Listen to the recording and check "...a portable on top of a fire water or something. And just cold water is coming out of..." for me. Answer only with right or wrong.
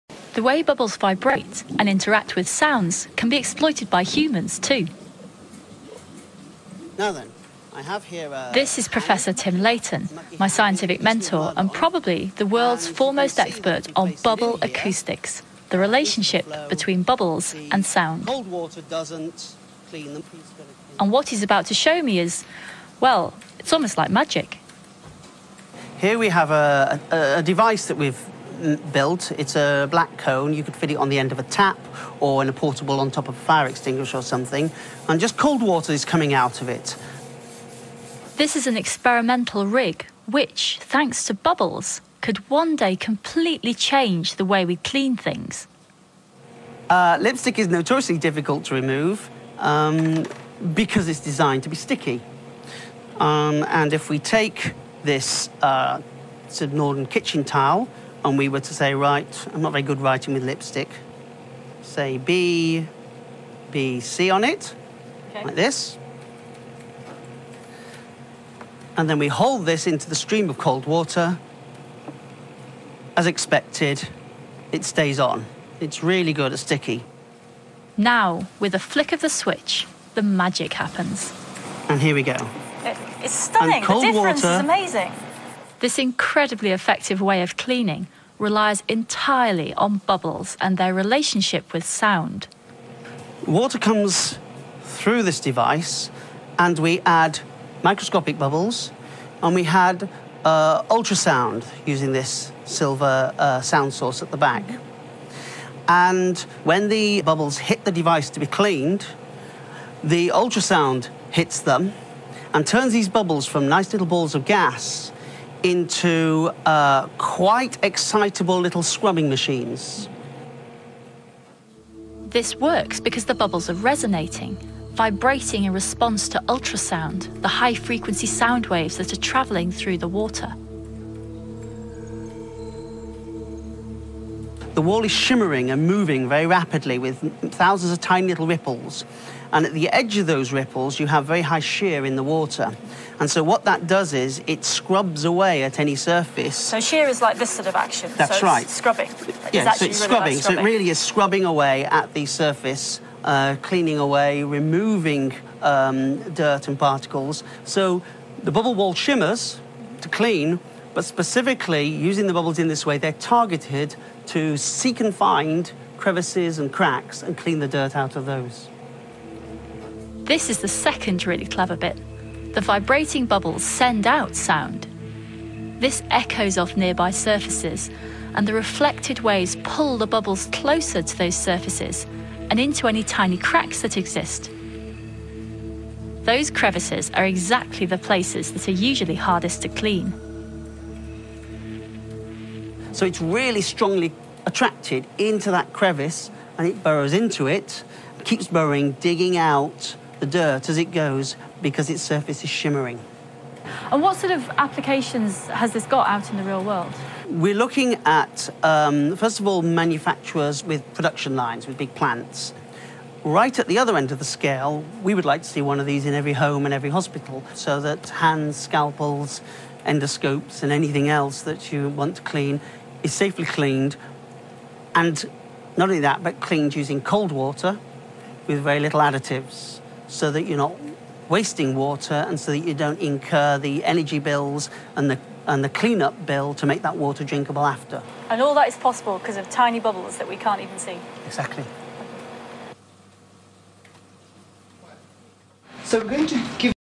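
wrong.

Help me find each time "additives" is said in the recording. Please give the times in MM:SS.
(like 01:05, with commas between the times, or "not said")
03:48.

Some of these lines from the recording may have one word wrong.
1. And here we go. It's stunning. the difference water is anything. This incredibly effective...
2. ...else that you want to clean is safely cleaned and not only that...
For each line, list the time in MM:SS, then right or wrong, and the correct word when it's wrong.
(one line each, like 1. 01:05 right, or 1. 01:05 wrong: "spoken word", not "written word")
1. 01:21 wrong: "amazing", not "anything"
2. 03:41 right.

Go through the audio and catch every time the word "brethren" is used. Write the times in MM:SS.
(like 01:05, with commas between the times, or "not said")
not said.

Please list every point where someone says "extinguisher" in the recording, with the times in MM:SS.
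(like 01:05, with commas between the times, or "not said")
00:33.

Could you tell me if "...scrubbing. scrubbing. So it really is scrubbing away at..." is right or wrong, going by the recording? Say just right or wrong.
right.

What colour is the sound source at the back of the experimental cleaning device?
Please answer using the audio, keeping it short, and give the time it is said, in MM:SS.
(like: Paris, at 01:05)
Silver, at 01:42.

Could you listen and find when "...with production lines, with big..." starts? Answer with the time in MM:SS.
03:30.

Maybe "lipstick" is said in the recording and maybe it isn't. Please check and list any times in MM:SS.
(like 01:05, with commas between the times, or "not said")
00:47, 01:00.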